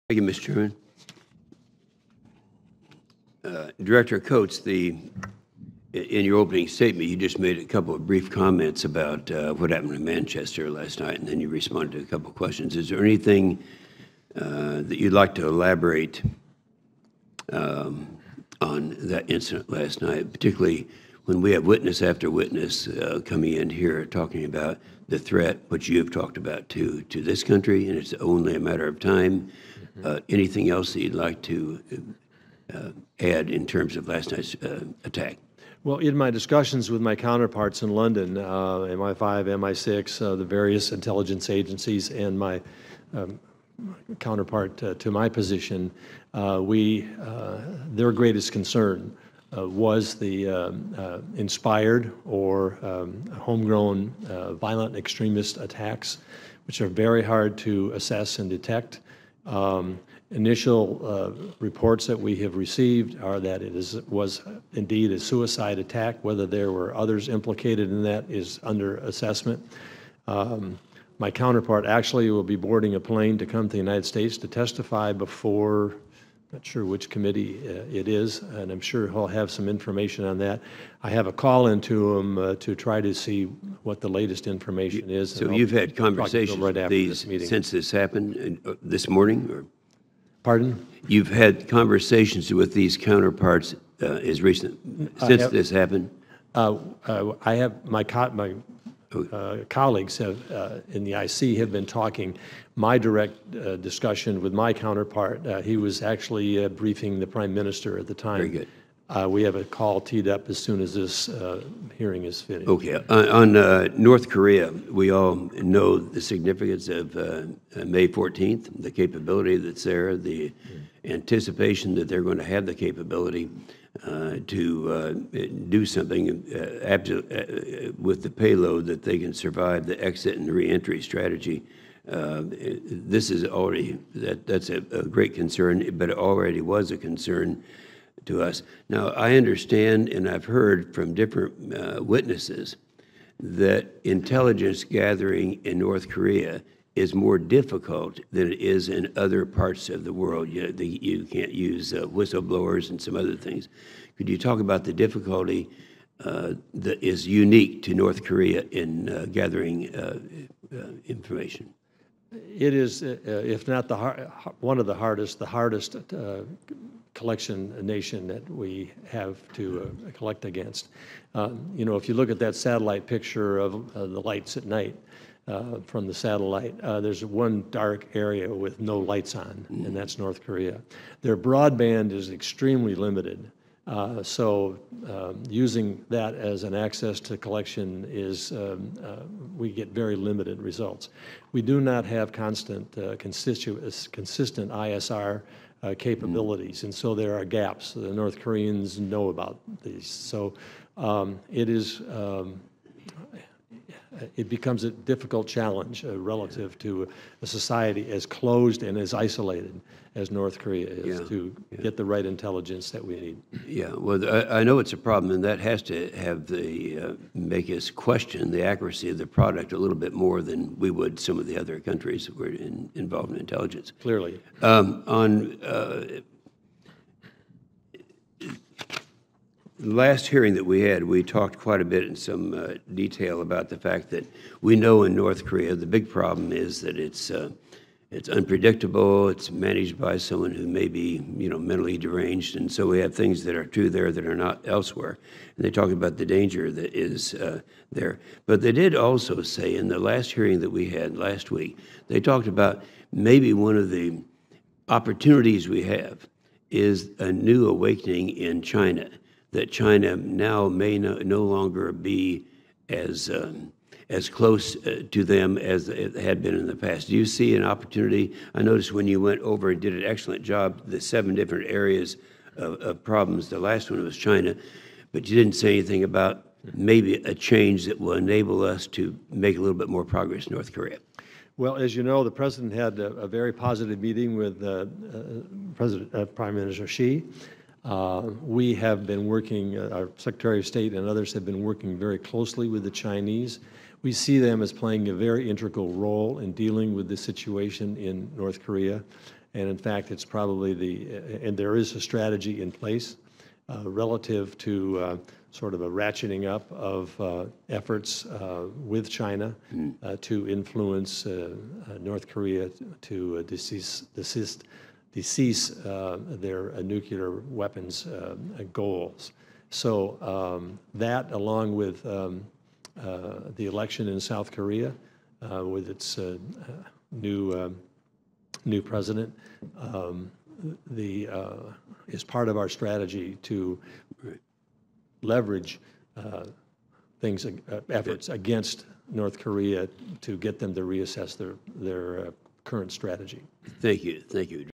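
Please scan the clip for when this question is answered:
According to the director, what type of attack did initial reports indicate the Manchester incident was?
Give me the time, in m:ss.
1:05.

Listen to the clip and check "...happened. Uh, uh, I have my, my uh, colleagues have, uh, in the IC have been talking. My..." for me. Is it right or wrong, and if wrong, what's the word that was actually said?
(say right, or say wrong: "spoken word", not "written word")
right.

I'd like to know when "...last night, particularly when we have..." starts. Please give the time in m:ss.
0:19.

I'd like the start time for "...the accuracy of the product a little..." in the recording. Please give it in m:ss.
3:38.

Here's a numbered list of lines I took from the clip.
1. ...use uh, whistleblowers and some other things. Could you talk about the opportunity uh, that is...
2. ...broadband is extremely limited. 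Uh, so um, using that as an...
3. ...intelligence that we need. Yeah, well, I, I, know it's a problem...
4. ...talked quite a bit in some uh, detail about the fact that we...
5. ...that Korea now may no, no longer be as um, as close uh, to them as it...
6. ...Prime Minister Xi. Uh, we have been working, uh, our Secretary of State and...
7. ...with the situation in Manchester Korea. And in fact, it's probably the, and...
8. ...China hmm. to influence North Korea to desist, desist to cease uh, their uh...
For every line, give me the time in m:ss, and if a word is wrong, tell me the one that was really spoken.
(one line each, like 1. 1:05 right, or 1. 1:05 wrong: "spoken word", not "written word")
1. 2:31 wrong: "difficulty", not "opportunity"
2. 3:01 right
3. 3:32 right
4. 3:51 right
5. 4:19 wrong: "China", not "Korea"
6. 4:46 right
7. 4:56 wrong: "North", not "Manchester"
8. 5:09 right.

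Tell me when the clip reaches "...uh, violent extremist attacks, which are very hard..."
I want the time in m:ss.
0:54.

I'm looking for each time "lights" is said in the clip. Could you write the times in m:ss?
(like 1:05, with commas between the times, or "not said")
2:54, 2:58.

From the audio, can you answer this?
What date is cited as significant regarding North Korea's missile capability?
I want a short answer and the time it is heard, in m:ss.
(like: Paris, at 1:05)
May 14th, at 1:57.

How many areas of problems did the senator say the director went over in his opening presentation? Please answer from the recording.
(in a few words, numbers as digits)
7.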